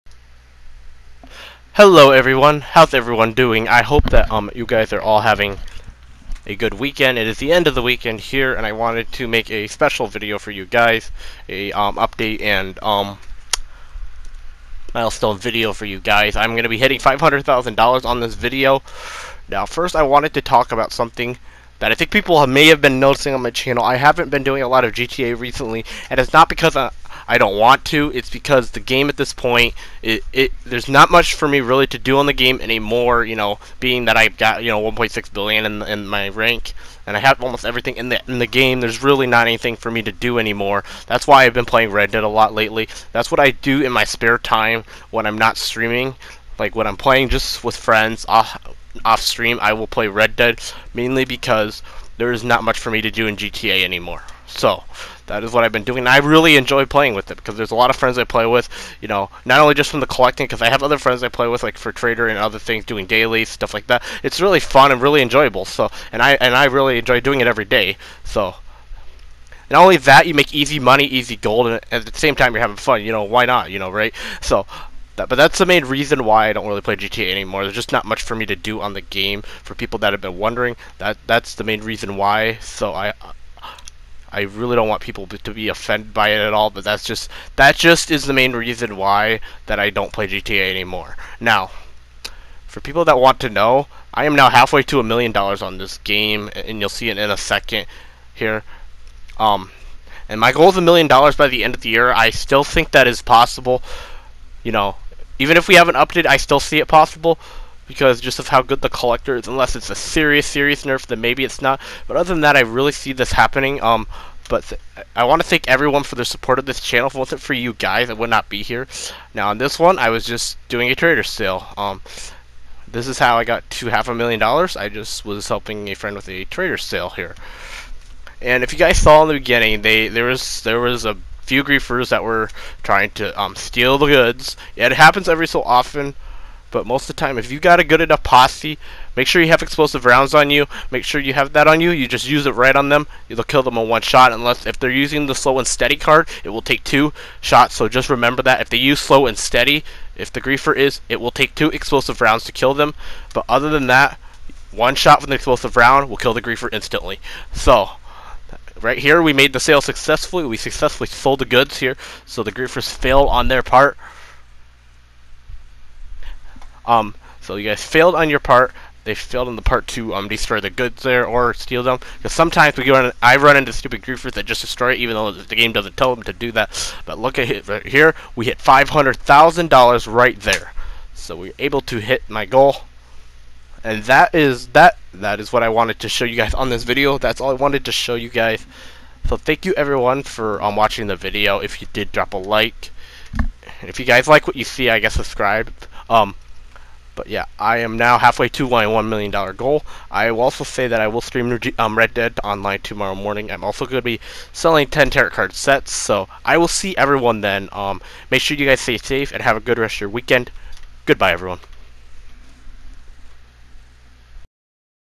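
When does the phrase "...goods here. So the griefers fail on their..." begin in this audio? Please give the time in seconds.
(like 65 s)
161 s.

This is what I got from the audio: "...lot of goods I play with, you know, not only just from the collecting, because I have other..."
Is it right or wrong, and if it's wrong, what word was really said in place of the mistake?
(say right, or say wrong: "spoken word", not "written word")
wrong: "friends", not "goods".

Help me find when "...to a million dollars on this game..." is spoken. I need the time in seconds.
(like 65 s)
94 s.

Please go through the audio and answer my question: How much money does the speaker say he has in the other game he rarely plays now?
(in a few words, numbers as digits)
1.6 billion.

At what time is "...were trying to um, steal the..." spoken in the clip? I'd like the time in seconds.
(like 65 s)
132 s.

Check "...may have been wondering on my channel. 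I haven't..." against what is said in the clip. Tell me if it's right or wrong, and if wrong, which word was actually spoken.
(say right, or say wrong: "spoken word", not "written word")
wrong: "noticing", not "wondering".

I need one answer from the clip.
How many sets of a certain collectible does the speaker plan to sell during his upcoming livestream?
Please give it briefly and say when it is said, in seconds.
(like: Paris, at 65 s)
10, at 204 s.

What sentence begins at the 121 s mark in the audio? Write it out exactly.
Um, this is how I got to half a million dollars.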